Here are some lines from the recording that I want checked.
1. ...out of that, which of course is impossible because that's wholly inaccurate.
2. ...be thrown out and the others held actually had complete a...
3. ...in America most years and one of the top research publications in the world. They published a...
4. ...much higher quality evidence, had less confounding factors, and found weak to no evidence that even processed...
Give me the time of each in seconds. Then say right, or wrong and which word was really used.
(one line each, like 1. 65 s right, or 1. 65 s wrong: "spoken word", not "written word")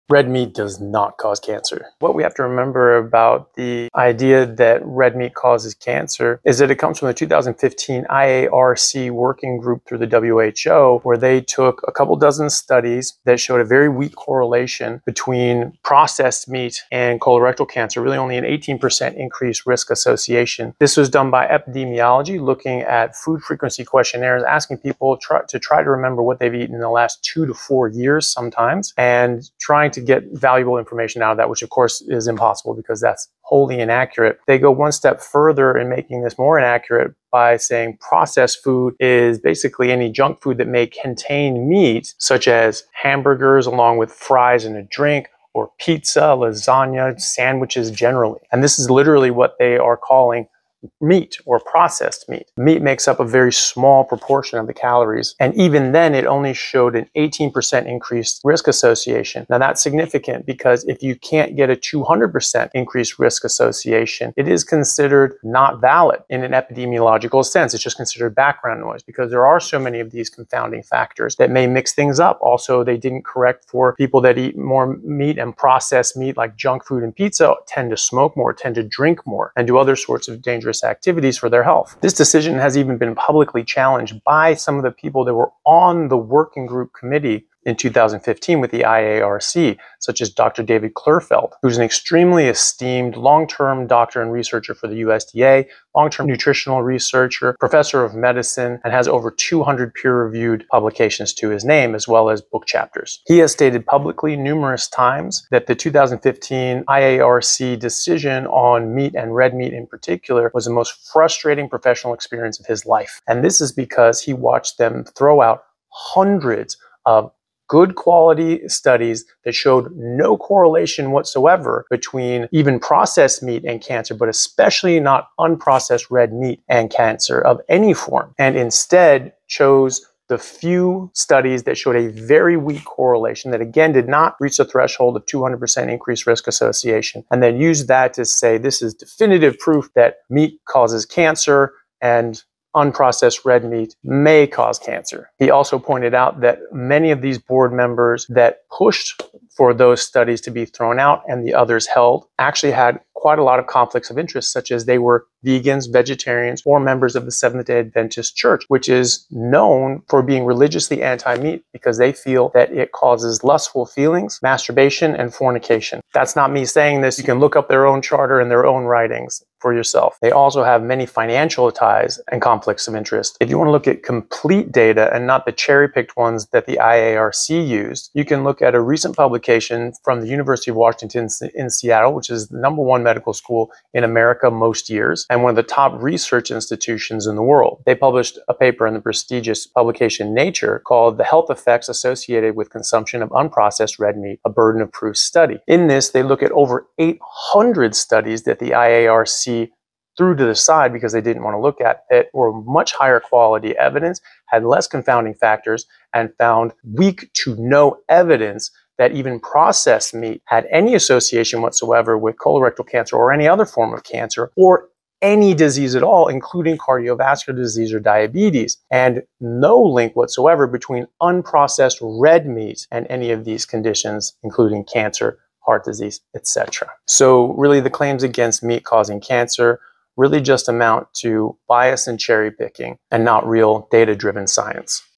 1. 31 s right
2. 150 s wrong: "quite", not "complete"
3. 183 s wrong: "institutions", not "publications"
4. 202 s right.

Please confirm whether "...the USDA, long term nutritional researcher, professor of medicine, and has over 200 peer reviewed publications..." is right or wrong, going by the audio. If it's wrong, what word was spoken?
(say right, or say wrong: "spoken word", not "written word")
right.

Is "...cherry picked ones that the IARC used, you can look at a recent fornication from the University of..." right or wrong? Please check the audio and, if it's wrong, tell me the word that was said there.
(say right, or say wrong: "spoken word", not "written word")
wrong: "publication", not "fornication".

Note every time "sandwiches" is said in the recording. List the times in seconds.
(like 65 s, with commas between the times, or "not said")
47 s.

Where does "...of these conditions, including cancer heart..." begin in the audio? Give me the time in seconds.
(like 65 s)
223 s.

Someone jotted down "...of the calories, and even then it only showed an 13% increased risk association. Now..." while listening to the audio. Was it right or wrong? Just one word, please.
wrong.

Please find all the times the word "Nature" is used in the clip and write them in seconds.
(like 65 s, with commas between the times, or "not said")
190 s.